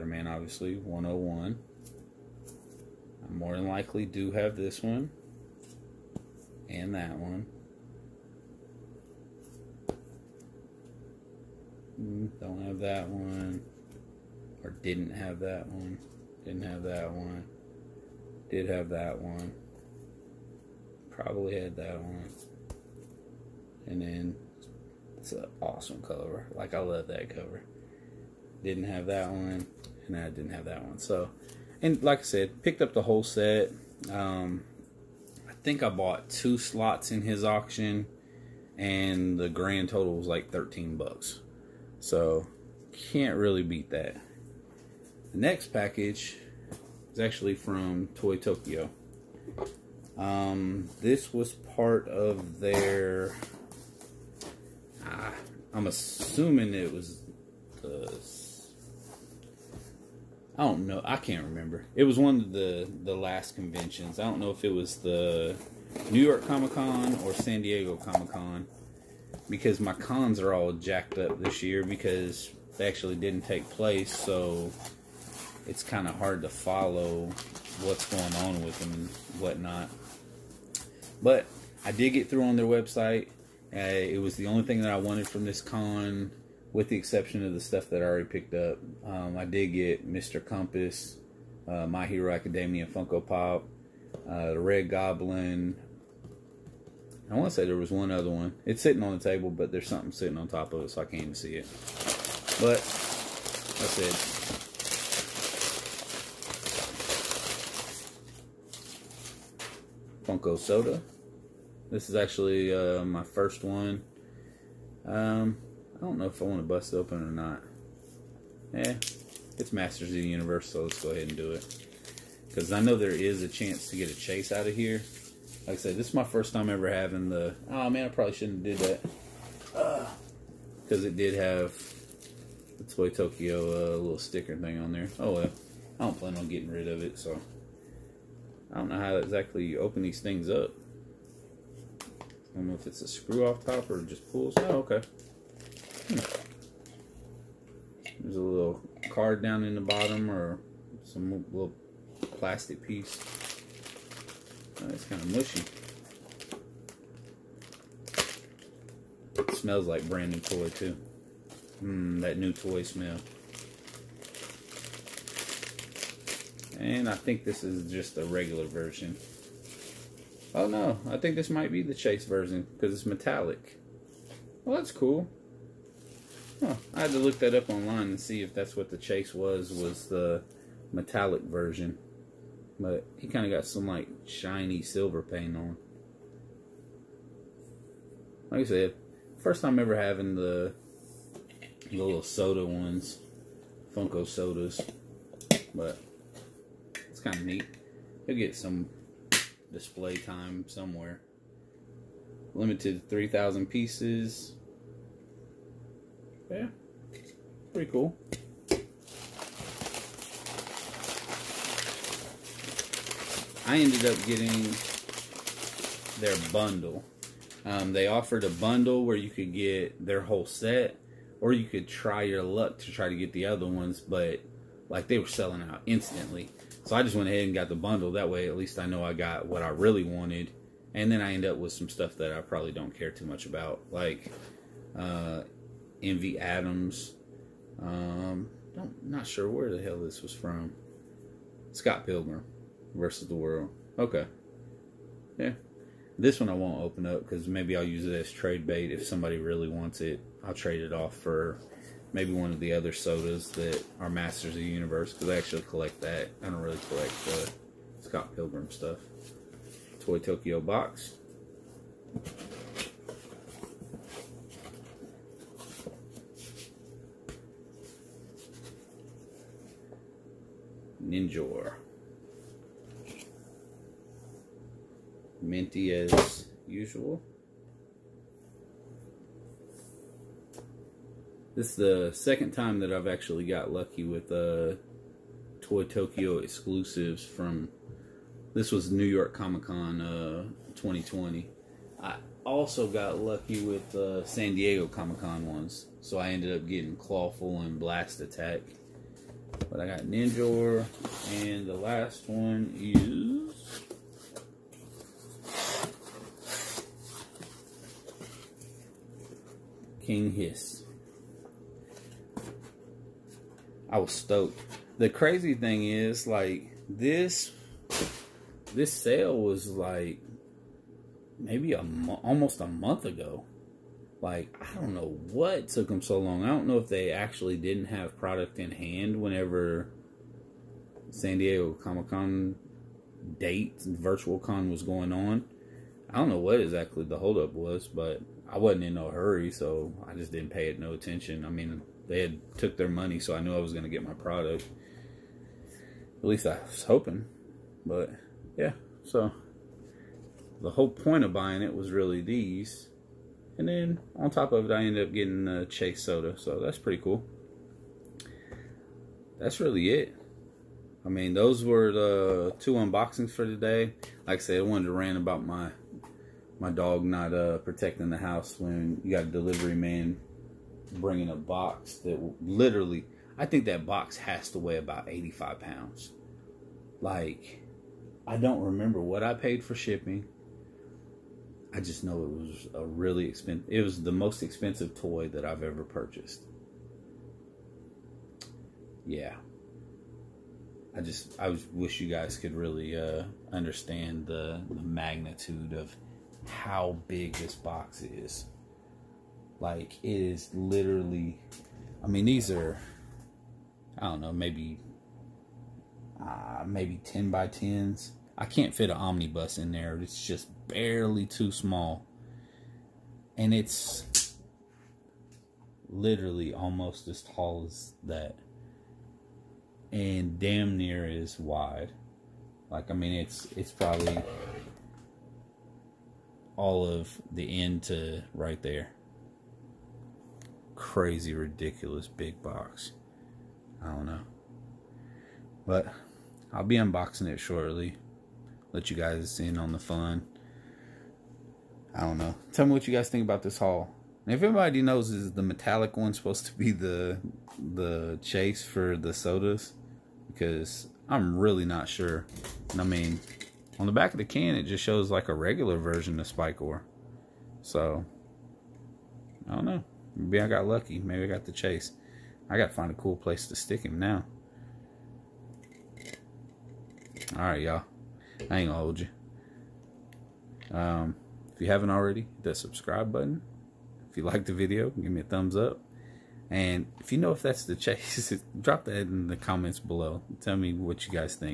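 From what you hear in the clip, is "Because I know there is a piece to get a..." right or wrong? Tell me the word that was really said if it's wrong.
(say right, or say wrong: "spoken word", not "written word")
wrong: "chance", not "piece".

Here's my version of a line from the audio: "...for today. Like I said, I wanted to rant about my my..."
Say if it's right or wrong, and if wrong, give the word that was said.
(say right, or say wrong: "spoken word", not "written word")
right.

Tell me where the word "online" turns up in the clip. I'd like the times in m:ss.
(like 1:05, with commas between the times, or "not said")
2:57.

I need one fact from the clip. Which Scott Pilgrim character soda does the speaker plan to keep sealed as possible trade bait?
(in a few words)
Envy Adams.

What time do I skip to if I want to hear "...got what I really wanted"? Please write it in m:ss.
3:49.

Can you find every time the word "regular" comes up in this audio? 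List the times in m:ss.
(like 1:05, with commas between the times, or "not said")
2:48, 7:35.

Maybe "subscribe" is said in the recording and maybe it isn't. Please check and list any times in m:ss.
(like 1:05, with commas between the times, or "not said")
7:52.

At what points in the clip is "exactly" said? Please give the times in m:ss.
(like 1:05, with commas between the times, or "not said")
2:19, 5:36.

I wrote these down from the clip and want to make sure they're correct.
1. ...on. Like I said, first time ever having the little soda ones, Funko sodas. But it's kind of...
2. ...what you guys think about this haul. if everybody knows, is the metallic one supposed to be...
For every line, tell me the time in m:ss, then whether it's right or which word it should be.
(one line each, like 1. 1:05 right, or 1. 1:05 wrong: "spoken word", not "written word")
1. 3:05 right
2. 7:22 right.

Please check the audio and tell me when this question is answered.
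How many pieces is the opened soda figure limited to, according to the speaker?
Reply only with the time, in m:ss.
3:23.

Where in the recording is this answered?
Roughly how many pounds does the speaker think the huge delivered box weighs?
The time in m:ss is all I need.
6:15.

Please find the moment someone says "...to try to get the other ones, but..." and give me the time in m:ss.
3:42.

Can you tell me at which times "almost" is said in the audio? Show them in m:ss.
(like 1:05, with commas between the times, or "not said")
5:22, 6:56.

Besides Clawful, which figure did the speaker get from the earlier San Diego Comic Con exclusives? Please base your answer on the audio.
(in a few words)
Blast-Attak.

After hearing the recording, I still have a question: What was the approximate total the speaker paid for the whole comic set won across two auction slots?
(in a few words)
13 bucks.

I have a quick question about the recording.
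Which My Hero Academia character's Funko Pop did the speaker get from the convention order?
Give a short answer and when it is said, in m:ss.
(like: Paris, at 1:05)
Mr. Compress, at 1:30.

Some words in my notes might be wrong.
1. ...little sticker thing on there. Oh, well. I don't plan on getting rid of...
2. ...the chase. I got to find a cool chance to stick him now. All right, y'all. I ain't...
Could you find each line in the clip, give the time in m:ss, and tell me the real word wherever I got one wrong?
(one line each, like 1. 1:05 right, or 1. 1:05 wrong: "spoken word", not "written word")
1. 2:13 right
2. 7:41 wrong: "place", not "chance".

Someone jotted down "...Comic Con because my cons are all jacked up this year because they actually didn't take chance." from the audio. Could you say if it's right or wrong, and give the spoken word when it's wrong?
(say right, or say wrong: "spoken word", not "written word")
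wrong: "place", not "chance".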